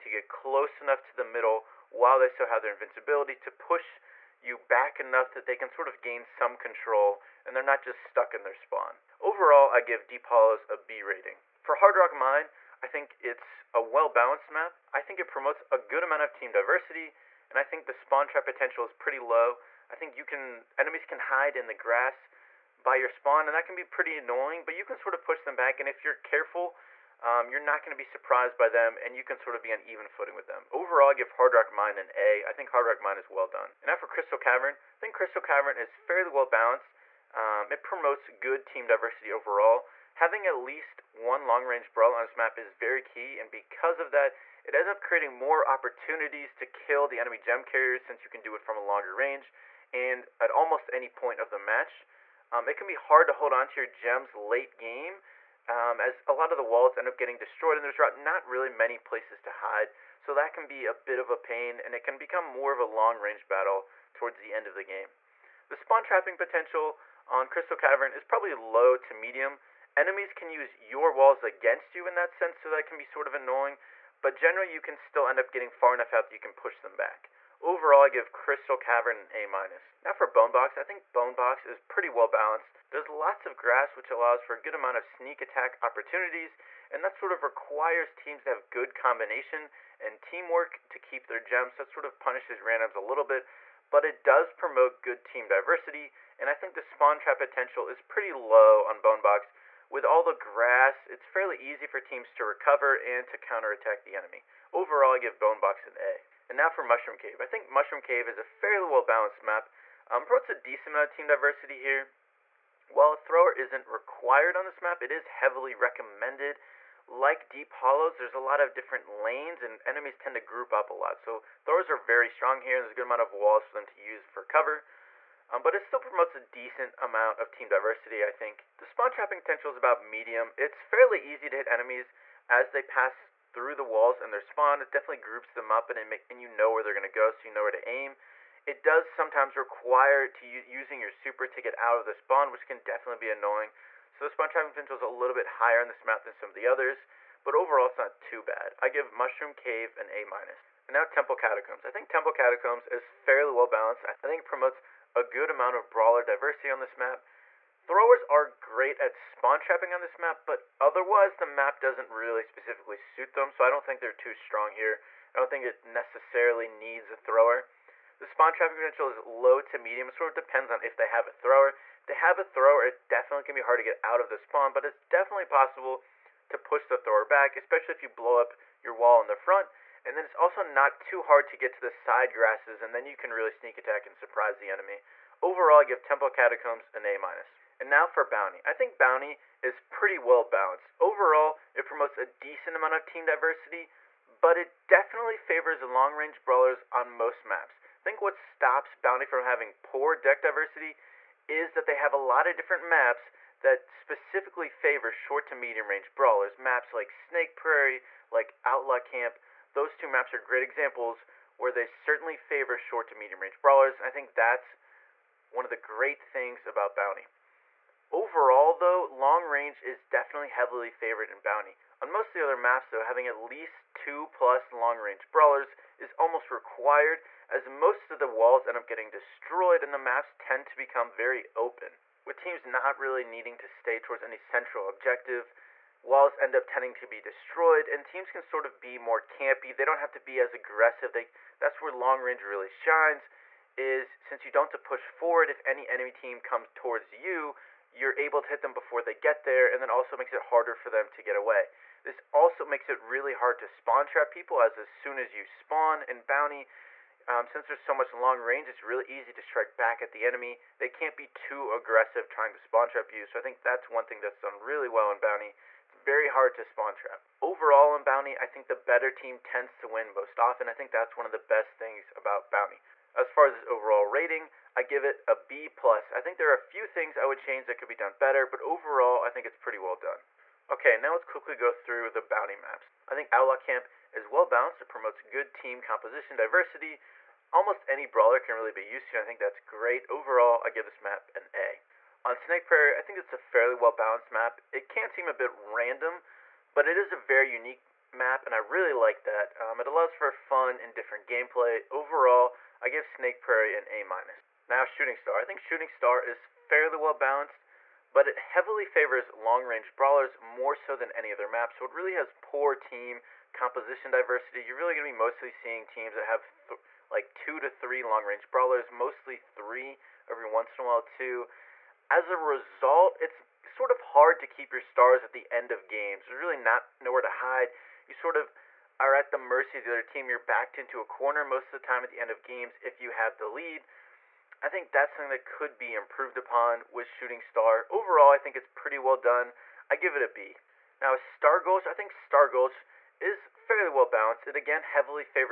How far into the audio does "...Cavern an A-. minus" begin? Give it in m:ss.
1:18.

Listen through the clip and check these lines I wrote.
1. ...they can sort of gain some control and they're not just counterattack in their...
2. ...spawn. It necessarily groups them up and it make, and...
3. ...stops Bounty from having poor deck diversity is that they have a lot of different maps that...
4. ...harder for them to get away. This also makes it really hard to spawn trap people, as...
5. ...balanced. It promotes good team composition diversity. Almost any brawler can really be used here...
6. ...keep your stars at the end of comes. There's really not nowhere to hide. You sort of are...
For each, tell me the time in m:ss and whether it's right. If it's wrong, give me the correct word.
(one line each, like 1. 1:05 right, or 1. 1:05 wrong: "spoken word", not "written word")
1. 0:05 wrong: "stuck", not "counterattack"
2. 2:14 wrong: "definitely", not "necessarily"
3. 3:18 right
4. 4:10 right
5. 4:44 right
6. 5:24 wrong: "games", not "comes".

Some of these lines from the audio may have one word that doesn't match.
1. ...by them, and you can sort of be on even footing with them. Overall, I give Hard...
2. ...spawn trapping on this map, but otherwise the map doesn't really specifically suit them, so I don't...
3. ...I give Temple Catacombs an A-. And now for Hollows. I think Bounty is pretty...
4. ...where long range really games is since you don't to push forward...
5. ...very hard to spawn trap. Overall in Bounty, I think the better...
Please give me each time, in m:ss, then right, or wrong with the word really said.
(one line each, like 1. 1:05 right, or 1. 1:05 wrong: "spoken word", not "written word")
1. 0:28 right
2. 2:39 right
3. 3:05 wrong: "Bounty", not "Hollows"
4. 4:01 wrong: "shines", not "games"
5. 4:25 right.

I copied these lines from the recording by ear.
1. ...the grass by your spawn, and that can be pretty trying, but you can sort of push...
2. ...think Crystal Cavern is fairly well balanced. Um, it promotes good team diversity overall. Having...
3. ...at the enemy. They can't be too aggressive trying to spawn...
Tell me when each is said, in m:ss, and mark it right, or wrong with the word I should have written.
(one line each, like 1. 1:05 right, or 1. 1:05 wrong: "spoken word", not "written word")
1. 0:21 wrong: "annoying", not "trying"
2. 0:34 right
3. 4:20 right.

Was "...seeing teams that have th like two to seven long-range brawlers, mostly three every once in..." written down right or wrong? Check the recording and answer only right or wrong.
wrong.